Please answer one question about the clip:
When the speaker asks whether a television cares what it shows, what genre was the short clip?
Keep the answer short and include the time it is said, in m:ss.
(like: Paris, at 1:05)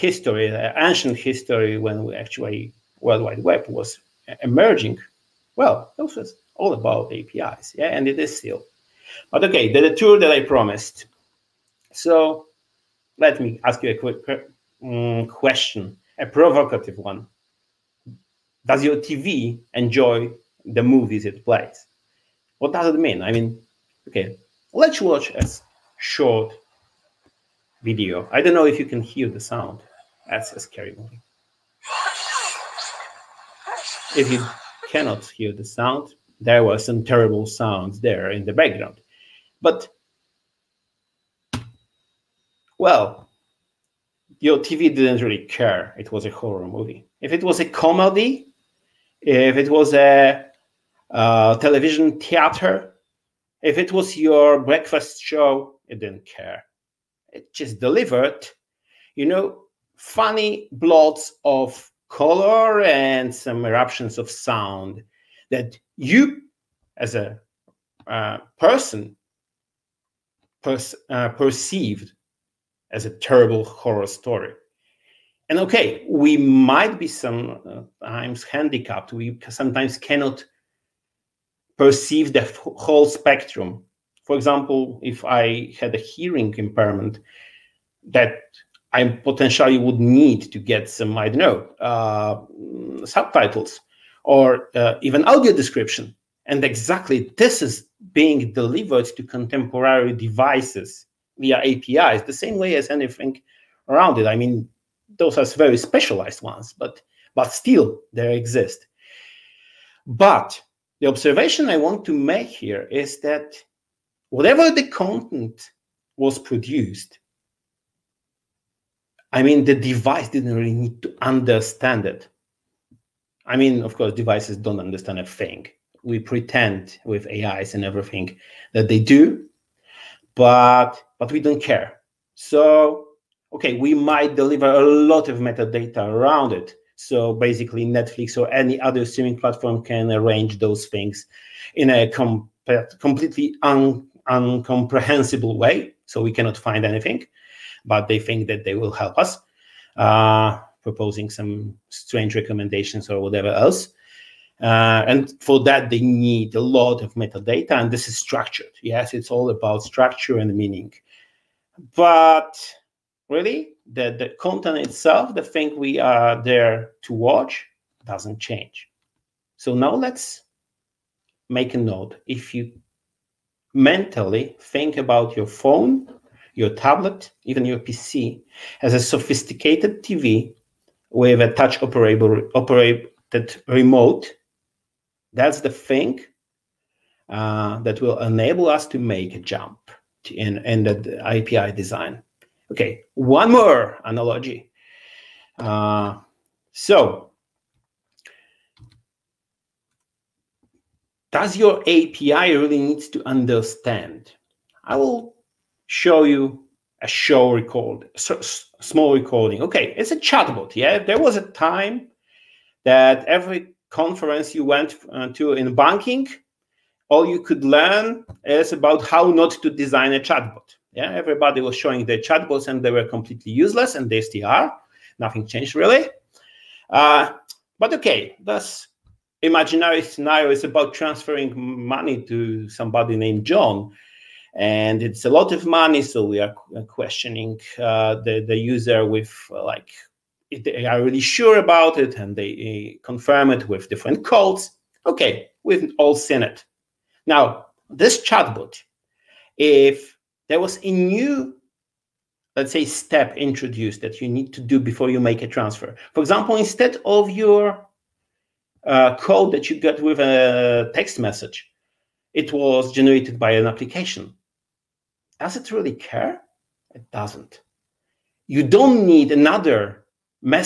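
horror movie, at 0:46.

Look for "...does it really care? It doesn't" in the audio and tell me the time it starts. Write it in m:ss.
4:25.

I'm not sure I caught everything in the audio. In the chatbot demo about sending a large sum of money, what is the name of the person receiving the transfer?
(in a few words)
John.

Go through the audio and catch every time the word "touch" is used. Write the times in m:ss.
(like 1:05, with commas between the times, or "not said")
3:01.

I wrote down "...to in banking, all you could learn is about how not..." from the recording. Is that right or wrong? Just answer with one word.
right.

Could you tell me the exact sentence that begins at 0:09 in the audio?
But okay, the, the tour that I promised.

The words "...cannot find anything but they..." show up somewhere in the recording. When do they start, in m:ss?
2:26.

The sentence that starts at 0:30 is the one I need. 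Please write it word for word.
That's a scary movie if you cannot hear the sound, there were some terrible sounds there in the background.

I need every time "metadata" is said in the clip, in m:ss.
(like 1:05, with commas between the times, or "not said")
2:15, 2:37.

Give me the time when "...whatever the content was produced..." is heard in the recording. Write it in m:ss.
1:54.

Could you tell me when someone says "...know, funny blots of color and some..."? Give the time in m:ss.
0:59.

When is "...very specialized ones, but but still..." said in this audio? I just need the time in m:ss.
1:45.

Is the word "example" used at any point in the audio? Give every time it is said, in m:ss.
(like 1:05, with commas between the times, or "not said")
1:24, 4:16.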